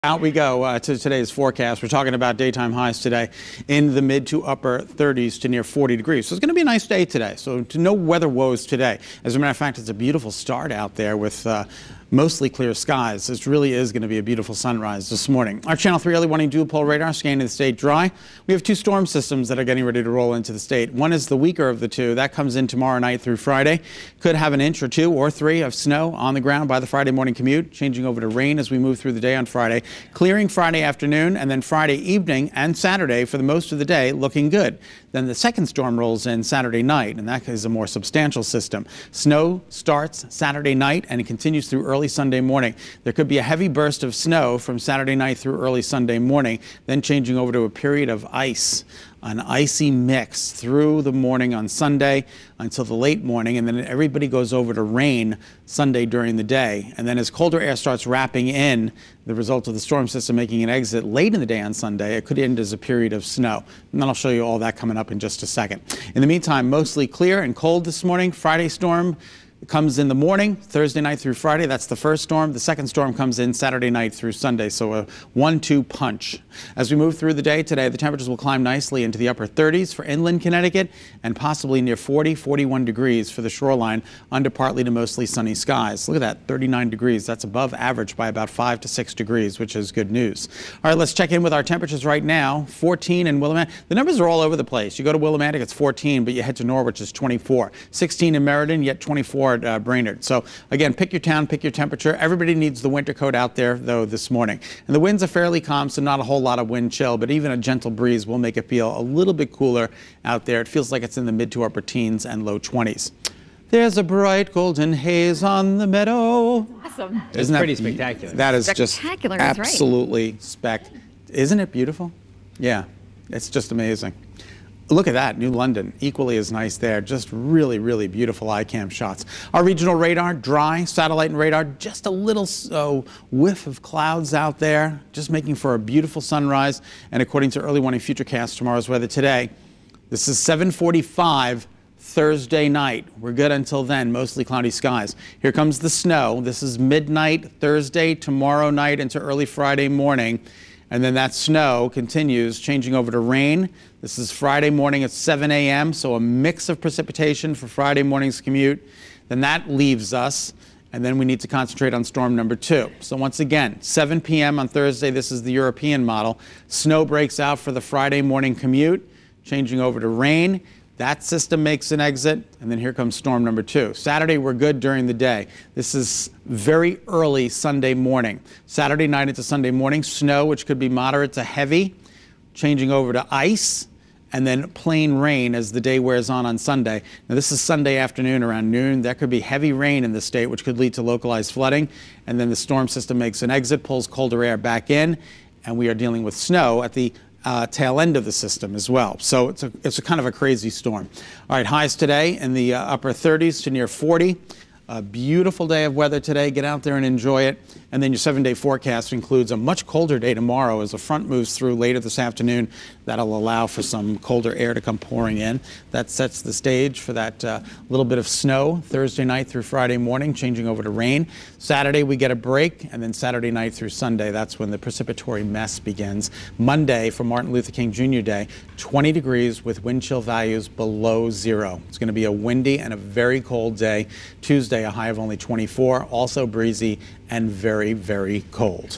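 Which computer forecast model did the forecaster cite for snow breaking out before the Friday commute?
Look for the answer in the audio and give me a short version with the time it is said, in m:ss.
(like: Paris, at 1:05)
European model, at 2:45.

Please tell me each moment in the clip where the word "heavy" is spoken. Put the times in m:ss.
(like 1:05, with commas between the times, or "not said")
0:43, 3:01, 3:09.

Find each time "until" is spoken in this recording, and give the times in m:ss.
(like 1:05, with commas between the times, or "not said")
0:52, 2:23.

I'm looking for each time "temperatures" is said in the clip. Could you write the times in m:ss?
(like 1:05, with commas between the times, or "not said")
1:17, 1:31, 1:41.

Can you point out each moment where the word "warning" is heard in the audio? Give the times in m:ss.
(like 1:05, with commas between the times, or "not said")
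0:16, 2:17.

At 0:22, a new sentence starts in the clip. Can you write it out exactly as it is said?
That comes in tomorrow night through Friday.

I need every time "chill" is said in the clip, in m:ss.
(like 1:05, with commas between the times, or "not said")
1:46, 3:50.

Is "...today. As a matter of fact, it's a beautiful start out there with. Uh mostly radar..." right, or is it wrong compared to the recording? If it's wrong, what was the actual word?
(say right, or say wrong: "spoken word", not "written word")
wrong: "clear", not "radar".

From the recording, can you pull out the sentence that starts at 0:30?
Clearing Friday afternoon and then Friday evening and Saturday for the most of the day looking good.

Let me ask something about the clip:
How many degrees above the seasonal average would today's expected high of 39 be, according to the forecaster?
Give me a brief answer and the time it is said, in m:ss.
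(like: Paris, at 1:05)
5 to 6 degrees, at 1:28.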